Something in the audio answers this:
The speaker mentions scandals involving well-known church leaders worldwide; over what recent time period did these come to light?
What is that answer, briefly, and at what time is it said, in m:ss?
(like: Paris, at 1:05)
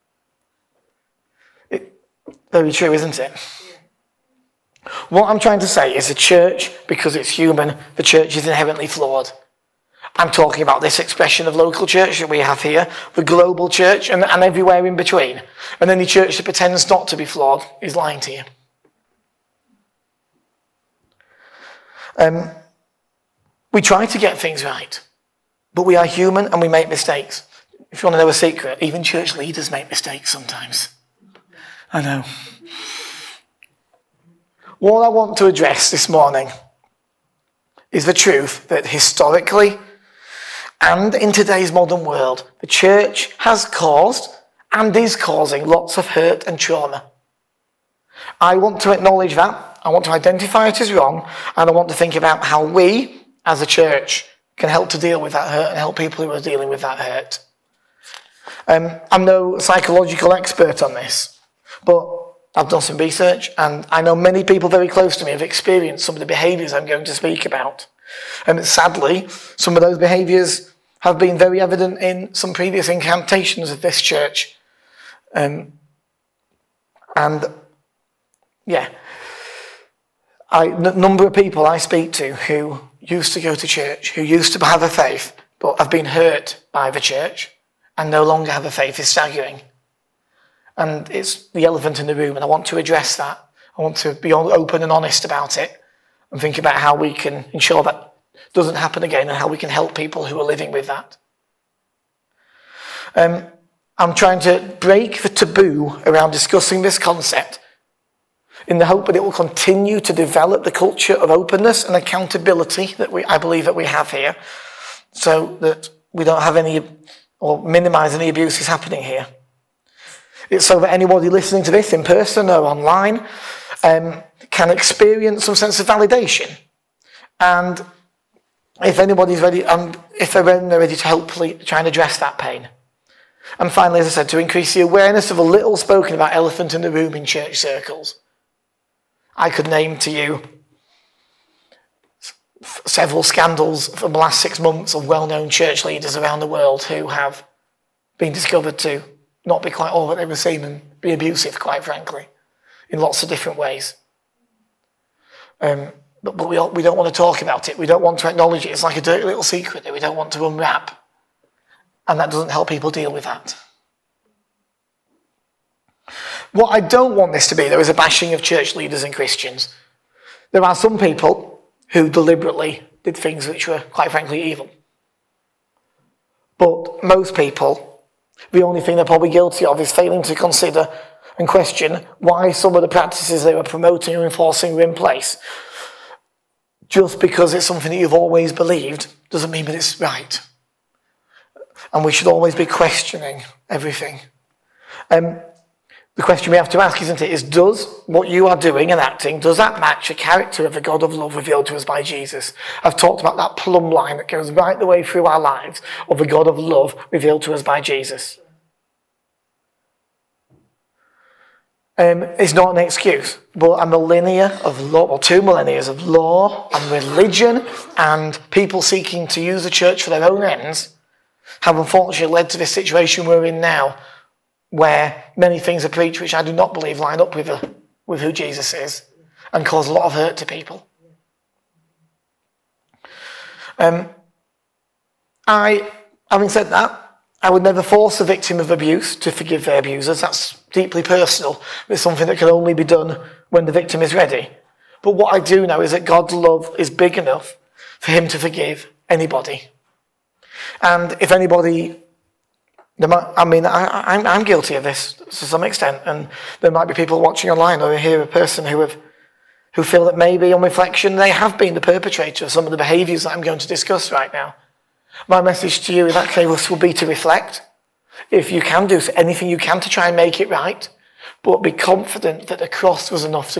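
Six months, at 2:24.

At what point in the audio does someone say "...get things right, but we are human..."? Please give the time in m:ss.
0:24.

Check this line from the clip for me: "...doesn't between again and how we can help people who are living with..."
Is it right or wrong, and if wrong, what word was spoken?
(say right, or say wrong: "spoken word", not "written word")
wrong: "happen", not "between".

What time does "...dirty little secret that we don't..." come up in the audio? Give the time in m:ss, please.
2:39.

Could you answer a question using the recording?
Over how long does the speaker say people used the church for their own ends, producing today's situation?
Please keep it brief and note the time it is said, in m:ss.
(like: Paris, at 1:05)
Two millennia, at 3:35.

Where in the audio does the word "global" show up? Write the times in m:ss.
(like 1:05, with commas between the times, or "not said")
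0:13.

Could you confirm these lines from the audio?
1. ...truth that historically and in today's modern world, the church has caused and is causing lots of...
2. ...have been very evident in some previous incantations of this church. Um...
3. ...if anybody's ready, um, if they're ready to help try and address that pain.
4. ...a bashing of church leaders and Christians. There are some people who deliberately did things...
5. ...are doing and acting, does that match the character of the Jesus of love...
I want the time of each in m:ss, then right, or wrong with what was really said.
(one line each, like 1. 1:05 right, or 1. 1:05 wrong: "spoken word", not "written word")
1. 0:38 right
2. 1:10 right
3. 2:08 right
4. 2:47 right
5. 3:18 wrong: "God", not "Jesus".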